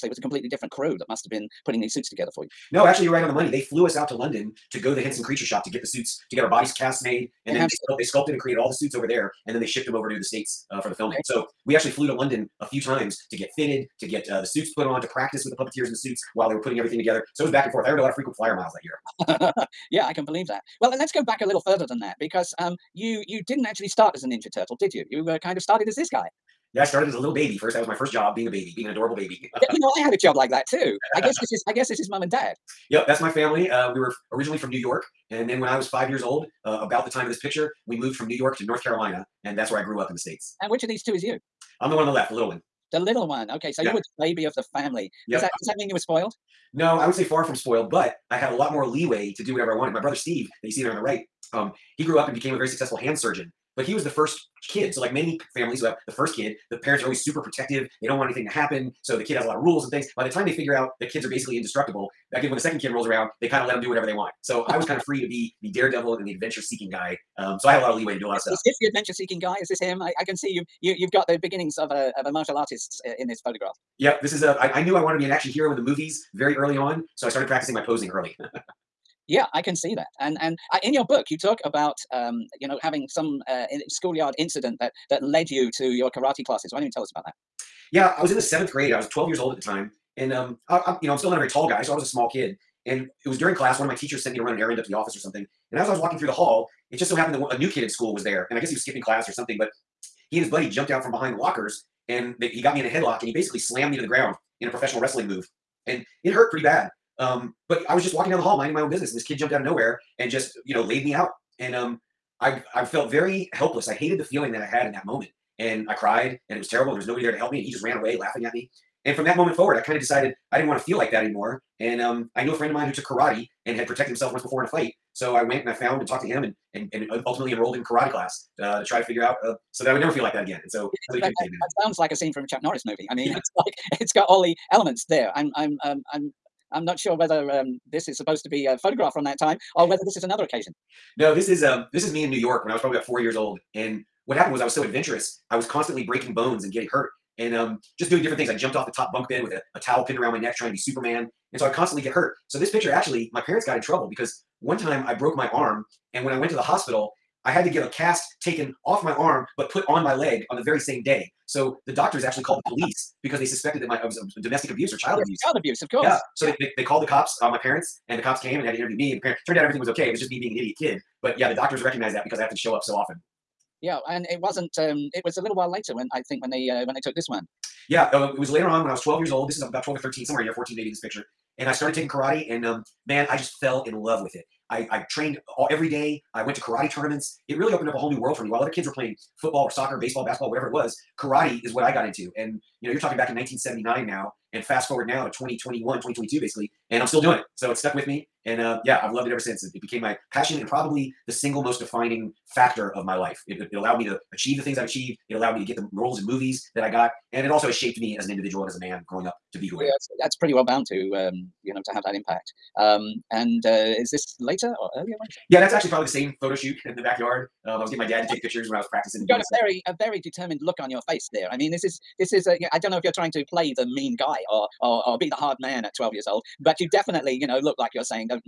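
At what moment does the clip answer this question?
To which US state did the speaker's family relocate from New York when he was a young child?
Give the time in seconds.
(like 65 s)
38 s.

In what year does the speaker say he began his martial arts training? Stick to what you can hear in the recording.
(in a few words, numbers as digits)
1979.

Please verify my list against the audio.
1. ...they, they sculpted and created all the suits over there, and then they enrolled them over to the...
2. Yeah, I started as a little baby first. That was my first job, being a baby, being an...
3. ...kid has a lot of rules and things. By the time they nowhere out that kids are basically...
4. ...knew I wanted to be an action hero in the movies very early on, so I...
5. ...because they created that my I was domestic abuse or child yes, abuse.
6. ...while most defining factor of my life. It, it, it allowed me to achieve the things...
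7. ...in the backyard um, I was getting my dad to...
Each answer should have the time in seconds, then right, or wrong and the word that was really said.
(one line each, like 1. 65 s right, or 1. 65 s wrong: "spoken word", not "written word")
1. 7 s wrong: "shipped", not "enrolled"
2. 26 s right
3. 59 s wrong: "figure", not "nowhere"
4. 74 s right
5. 163 s wrong: "suspected", not "created"
6. 201 s wrong: "single", not "while"
7. 216 s right.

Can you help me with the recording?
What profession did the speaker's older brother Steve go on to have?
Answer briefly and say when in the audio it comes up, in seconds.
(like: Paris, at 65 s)
Hand surgeon, at 52 s.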